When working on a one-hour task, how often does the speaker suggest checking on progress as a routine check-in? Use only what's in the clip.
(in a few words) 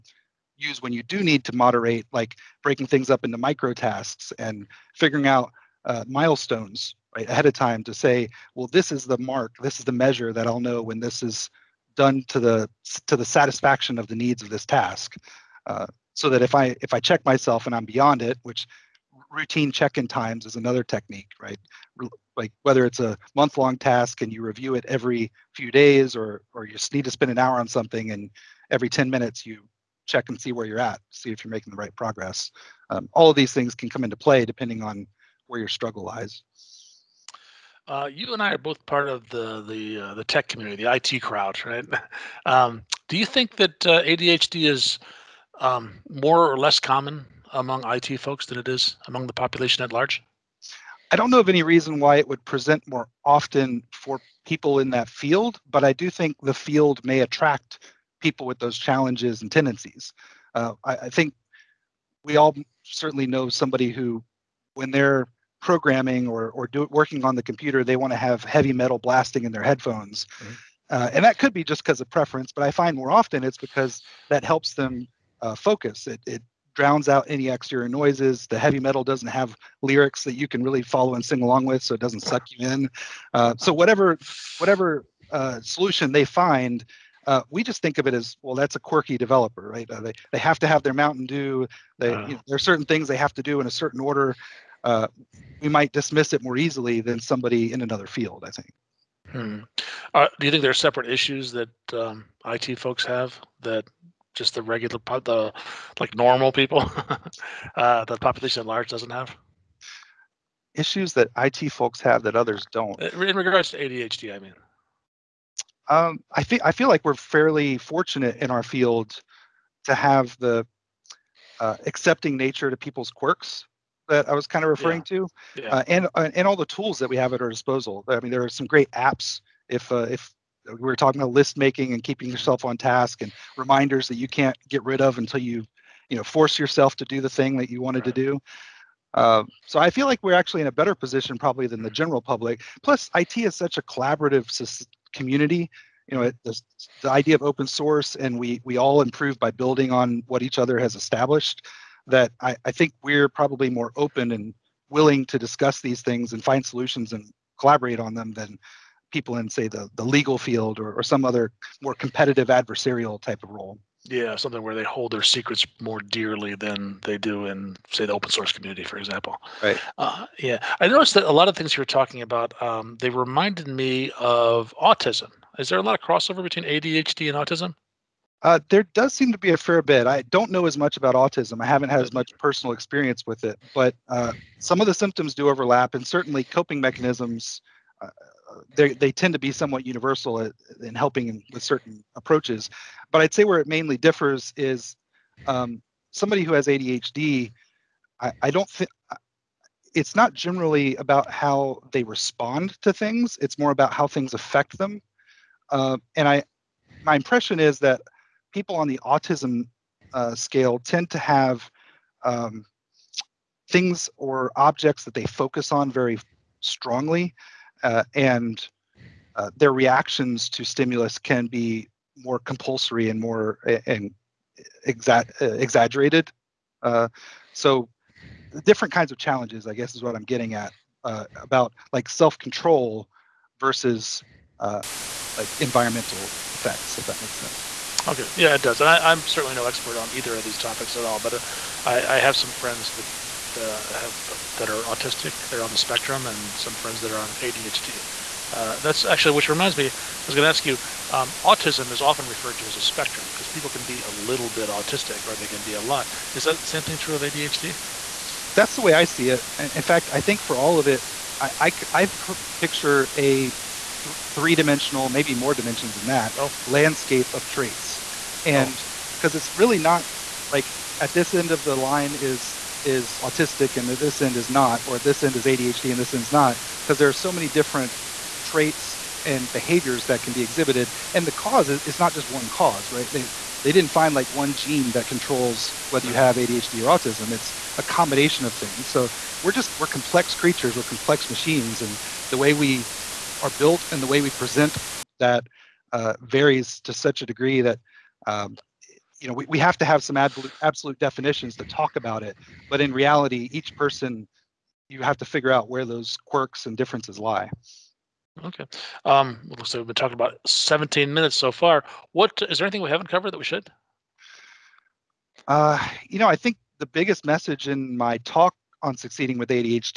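every 10 minutes.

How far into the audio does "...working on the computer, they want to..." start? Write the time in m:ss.
1:06.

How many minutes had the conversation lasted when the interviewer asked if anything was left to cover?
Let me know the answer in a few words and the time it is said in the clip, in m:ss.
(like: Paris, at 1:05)
17 minutes, at 5:10.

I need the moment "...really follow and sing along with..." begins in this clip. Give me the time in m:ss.
1:20.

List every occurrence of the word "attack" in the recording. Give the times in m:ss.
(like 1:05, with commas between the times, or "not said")
not said.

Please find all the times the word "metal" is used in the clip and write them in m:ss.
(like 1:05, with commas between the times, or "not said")
1:08, 1:18.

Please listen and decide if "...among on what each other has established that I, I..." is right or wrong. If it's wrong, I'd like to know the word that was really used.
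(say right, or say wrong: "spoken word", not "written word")
wrong: "building", not "among".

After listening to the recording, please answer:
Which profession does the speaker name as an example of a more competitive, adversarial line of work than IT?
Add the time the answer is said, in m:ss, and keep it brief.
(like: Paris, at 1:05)
legal field, at 2:40.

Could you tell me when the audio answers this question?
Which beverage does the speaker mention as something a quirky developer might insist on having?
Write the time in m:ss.
1:30.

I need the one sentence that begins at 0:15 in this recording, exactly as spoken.
Uh, so that if I if I check myself and I'm beyond it, which routine check-in times is another technique, right?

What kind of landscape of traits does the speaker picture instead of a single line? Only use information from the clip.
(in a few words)
three-dimensional.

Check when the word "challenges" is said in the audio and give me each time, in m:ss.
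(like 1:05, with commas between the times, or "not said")
0:58, 3:49.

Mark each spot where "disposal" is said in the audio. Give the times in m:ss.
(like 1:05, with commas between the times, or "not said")
2:07.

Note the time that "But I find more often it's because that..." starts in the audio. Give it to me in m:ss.
1:12.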